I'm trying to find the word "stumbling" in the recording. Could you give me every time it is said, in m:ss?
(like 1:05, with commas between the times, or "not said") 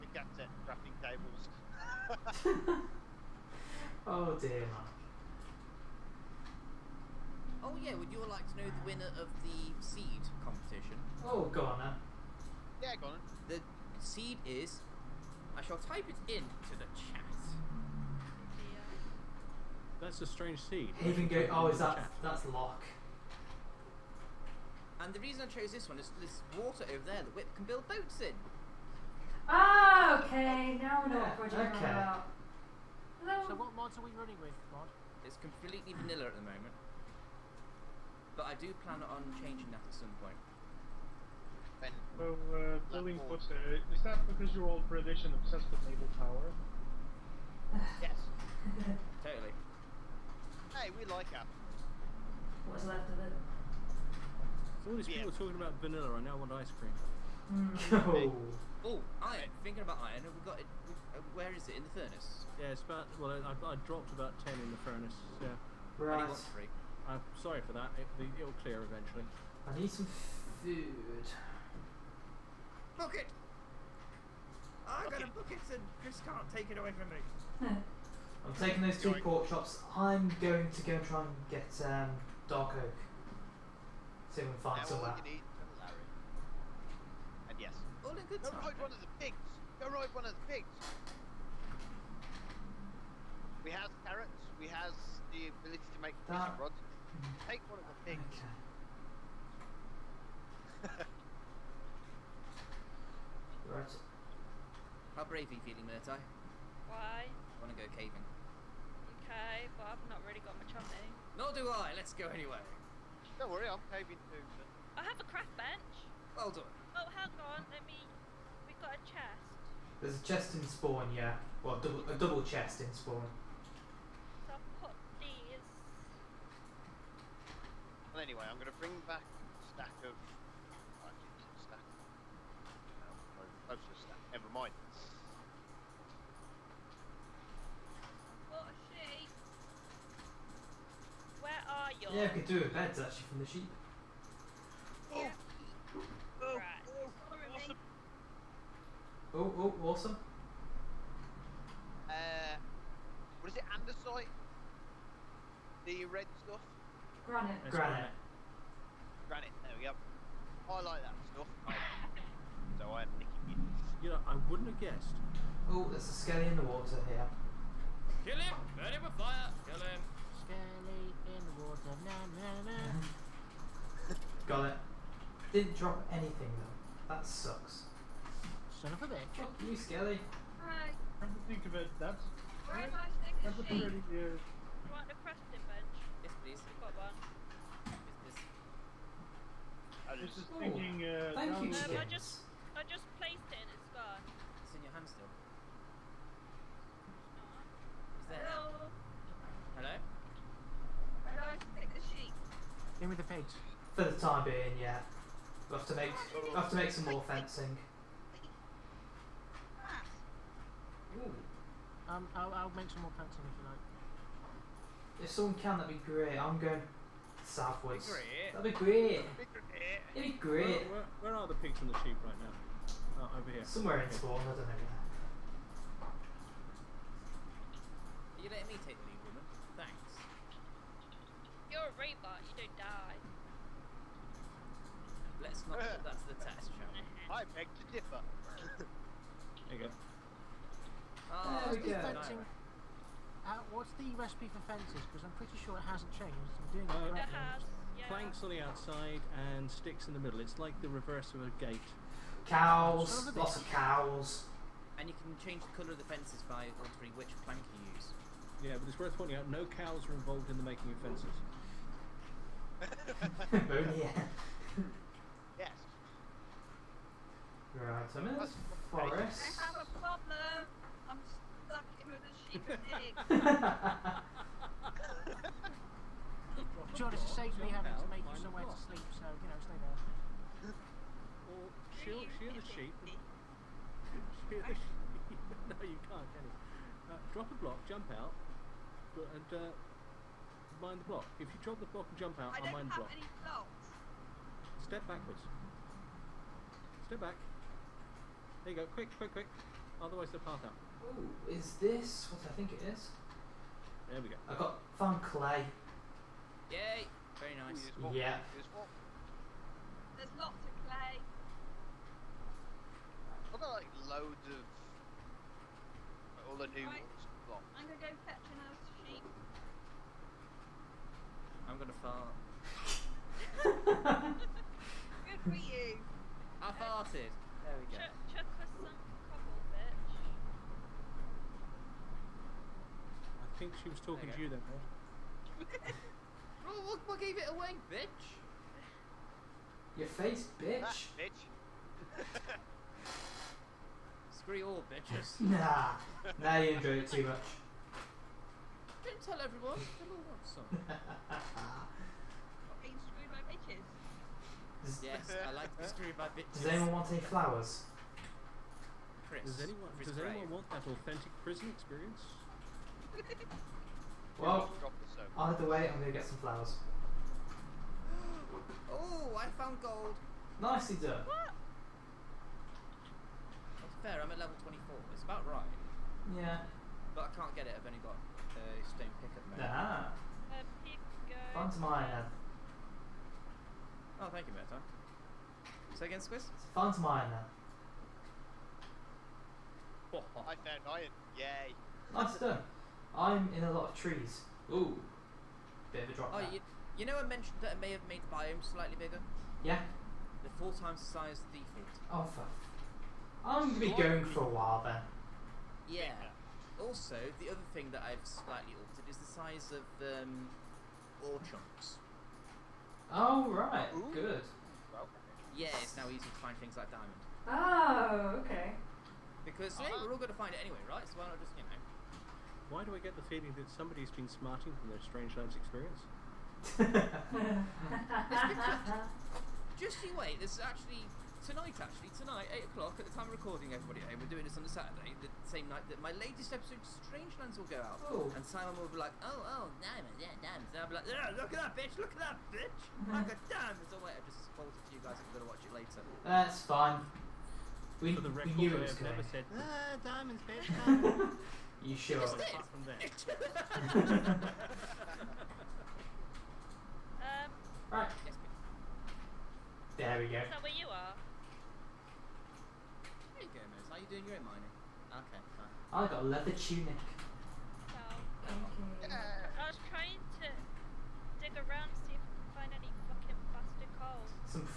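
not said.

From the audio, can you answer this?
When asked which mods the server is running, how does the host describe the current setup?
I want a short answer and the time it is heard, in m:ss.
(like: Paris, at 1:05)
Completely vanilla, at 0:35.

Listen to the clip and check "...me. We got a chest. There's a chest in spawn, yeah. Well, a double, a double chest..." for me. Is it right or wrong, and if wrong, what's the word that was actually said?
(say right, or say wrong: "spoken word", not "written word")
right.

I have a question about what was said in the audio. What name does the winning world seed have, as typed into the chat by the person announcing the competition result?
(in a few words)
Haven Gate.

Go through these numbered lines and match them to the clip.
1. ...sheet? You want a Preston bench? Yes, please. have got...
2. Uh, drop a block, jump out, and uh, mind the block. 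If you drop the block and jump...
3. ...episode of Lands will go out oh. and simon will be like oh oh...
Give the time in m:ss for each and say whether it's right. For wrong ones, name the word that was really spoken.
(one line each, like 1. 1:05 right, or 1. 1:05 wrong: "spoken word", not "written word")
1. 3:03 right
2. 4:47 right
3. 7:16 right.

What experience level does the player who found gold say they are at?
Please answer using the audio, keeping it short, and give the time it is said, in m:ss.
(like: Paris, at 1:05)
24, at 6:14.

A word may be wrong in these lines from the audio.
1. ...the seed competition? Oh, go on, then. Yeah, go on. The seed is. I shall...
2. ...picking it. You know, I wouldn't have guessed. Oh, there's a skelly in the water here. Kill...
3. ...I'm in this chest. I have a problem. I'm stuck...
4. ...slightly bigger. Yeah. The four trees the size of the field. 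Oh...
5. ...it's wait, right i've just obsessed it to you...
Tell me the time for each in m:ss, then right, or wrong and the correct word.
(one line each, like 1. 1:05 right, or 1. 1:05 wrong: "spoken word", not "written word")
1. 0:09 right
2. 2:43 right
3. 4:28 wrong: "forest", not "chest"
4. 6:38 wrong: "times", not "trees"
5. 7:23 wrong: "spoiled", not "obsessed".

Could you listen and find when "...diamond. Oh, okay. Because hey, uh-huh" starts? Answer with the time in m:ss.
6:56.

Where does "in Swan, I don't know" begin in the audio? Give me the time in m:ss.
3:44.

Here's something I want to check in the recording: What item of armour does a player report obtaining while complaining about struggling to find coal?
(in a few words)
Leather tunic.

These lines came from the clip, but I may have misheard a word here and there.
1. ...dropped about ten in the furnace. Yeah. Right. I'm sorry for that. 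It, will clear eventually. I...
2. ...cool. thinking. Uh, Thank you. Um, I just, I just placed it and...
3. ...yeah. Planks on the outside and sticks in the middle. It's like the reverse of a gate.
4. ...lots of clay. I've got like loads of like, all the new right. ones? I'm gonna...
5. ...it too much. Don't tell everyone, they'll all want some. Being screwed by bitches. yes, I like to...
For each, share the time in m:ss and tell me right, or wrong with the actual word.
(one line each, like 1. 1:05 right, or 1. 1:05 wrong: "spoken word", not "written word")
1. 1:03 right
2. 3:10 right
3. 4:07 right
4. 5:10 right
5. 5:47 right.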